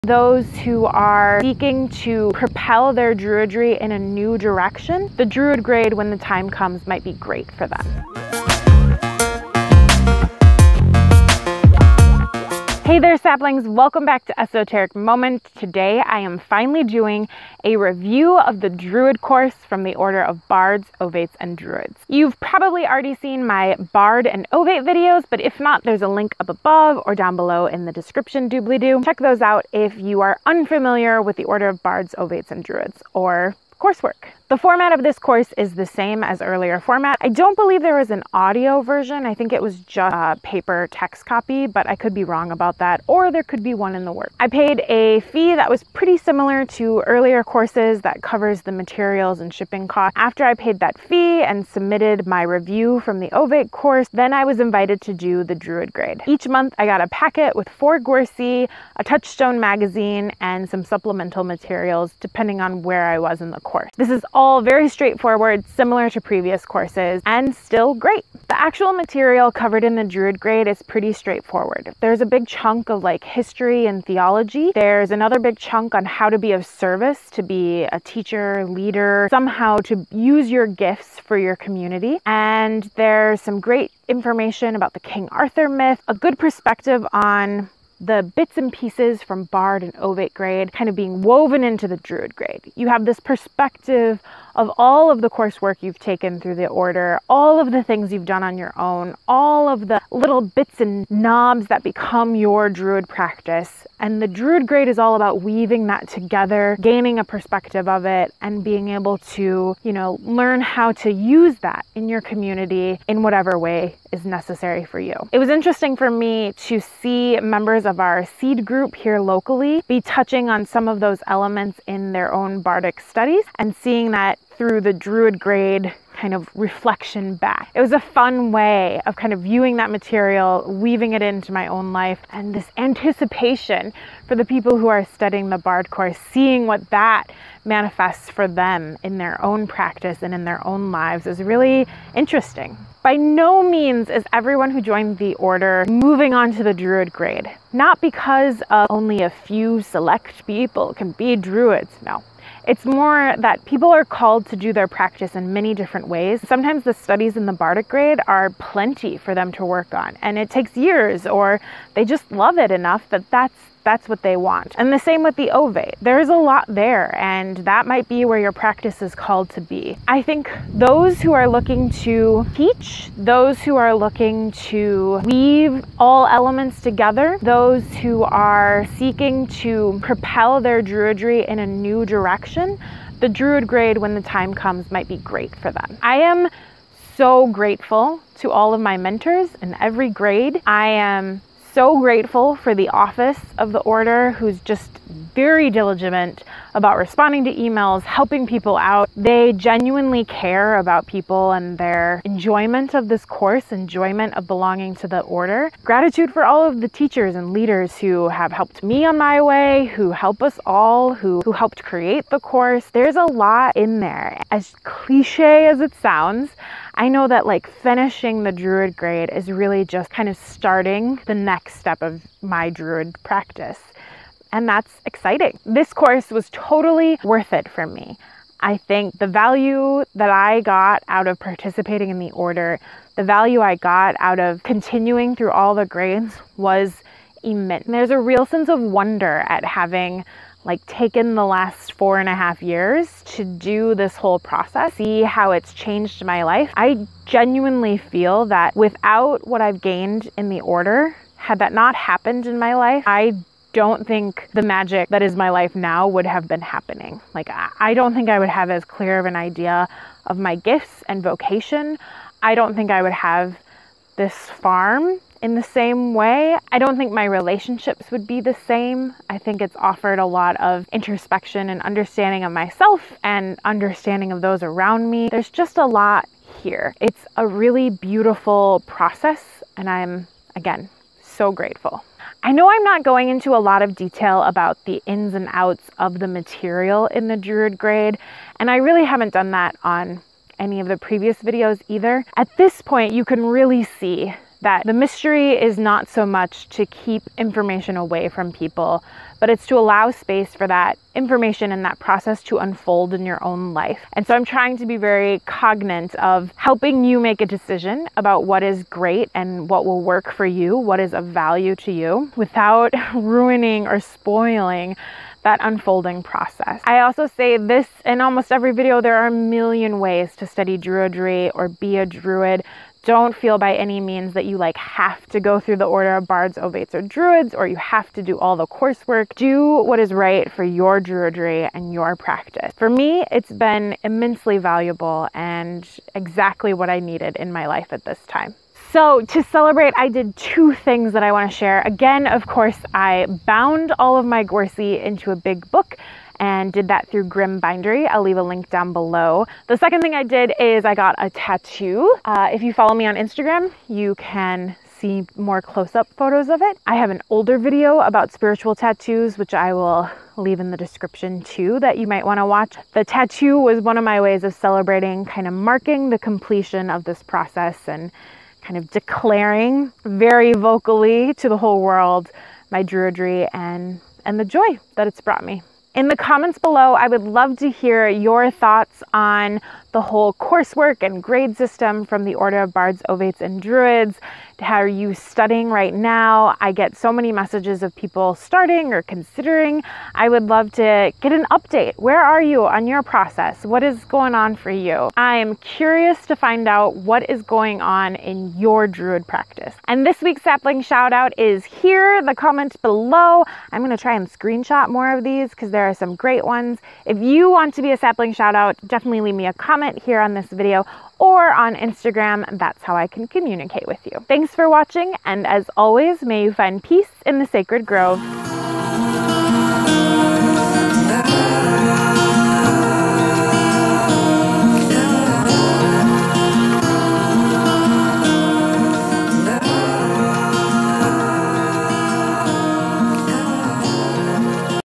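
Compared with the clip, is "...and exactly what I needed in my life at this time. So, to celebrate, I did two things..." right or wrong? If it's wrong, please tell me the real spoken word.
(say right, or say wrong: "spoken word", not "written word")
right.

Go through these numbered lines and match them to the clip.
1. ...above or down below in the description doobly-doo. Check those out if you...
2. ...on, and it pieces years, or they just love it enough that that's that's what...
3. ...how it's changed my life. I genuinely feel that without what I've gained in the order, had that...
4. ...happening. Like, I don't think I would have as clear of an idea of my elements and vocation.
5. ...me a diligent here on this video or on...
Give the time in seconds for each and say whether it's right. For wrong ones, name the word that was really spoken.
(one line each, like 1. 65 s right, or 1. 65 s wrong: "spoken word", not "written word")
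1. 26 s right
2. 159 s wrong: "takes", not "pieces"
3. 245 s right
4. 256 s wrong: "gifts", not "elements"
5. 409 s wrong: "comment", not "diligent".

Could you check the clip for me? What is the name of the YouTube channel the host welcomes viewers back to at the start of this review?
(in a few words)
Esoteric Moment.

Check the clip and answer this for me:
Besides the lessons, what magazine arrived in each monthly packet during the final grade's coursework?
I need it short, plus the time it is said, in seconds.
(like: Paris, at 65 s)
Touchstone, at 59 s.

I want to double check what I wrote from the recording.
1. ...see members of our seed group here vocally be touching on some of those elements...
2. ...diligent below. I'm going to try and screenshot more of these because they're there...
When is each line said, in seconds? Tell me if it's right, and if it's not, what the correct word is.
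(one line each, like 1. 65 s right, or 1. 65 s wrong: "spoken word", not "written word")
1. 116 s wrong: "locally", not "vocally"
2. 402 s wrong: "comment", not "diligent".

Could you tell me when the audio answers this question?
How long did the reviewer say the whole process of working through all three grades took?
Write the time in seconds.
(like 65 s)
241 s.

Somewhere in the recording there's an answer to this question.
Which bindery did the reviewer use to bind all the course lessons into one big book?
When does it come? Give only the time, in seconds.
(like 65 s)
347 s.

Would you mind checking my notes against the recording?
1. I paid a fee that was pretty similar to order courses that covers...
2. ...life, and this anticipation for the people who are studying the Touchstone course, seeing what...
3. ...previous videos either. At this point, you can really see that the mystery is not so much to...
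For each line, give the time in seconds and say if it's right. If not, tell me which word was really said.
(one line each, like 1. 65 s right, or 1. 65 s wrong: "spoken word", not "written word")
1. 44 s wrong: "earlier", not "order"
2. 131 s wrong: "Bard", not "Touchstone"
3. 290 s right.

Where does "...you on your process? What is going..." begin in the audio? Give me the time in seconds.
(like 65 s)
392 s.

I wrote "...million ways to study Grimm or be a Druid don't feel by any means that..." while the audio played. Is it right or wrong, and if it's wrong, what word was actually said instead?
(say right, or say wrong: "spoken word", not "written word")
wrong: "Druidry", not "Grimm".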